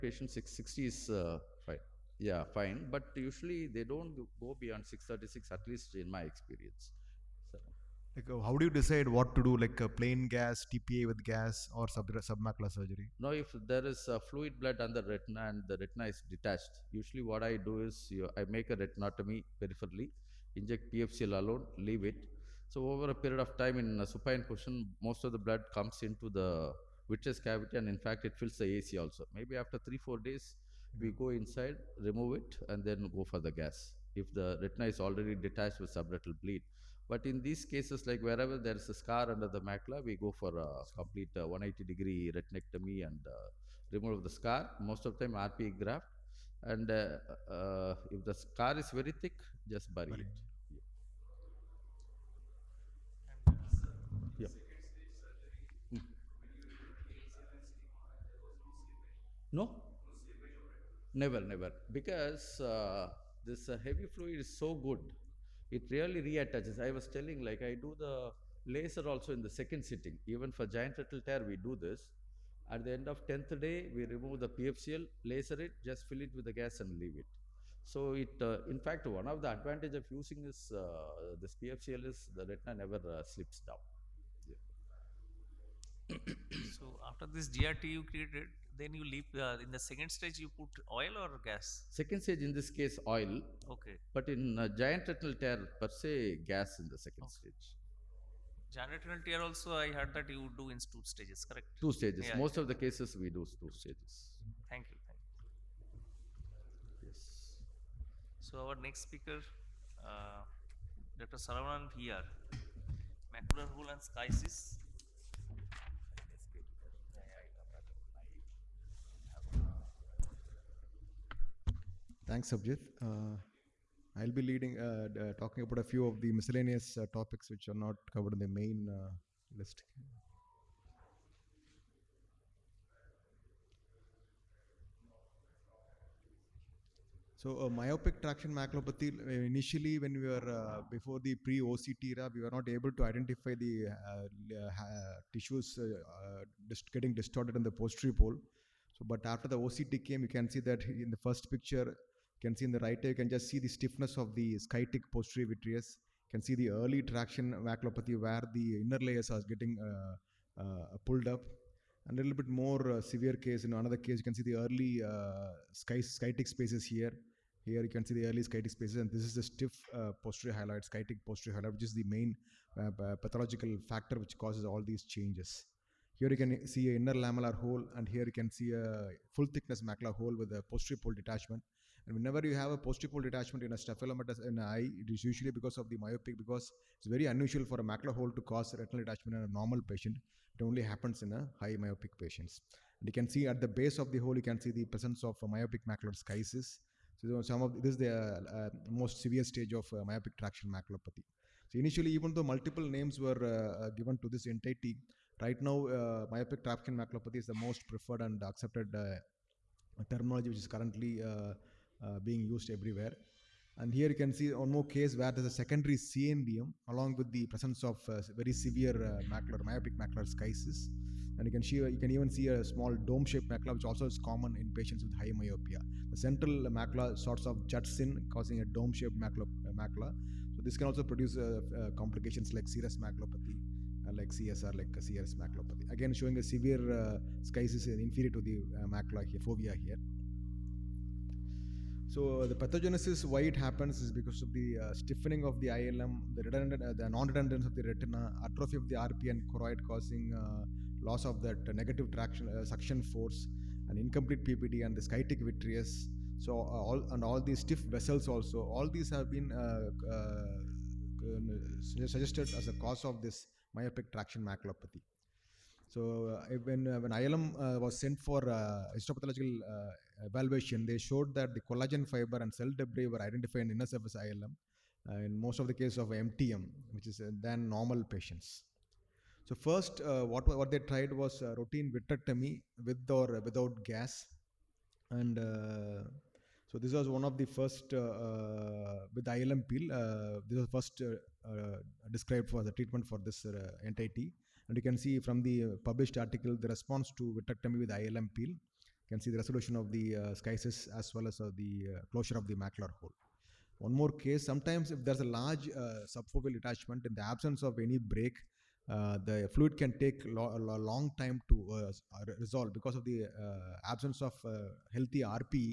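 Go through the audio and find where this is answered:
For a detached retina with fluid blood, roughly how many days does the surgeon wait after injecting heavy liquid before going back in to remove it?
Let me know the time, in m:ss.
0:29.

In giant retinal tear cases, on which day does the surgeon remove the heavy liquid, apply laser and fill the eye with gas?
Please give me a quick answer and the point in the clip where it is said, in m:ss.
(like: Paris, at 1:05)
10th day, at 1:13.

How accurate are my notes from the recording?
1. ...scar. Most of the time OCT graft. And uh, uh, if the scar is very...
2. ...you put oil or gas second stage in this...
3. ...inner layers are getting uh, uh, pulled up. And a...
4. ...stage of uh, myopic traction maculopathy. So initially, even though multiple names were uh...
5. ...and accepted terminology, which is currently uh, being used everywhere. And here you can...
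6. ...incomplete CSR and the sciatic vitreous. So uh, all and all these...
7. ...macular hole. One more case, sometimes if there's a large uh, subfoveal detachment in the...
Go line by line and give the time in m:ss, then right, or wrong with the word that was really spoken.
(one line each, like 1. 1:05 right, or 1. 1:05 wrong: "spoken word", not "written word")
1. 0:44 wrong: "RPE", not "OCT"
2. 1:30 right
3. 2:38 right
4. 3:19 right
5. 3:28 right
6. 4:13 wrong: "PPD", not "CSR"
7. 5:02 right.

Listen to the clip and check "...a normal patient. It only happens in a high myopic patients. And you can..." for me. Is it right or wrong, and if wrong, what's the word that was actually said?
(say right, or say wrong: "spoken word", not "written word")
right.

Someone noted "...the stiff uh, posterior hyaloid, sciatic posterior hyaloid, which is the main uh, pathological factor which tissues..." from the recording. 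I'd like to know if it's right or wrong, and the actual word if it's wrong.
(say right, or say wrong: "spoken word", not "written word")
wrong: "causes", not "tissues".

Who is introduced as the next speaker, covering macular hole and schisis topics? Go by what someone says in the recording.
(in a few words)
Dr Saravanan.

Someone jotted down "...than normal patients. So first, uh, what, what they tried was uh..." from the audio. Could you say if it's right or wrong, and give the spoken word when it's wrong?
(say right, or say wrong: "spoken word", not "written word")
right.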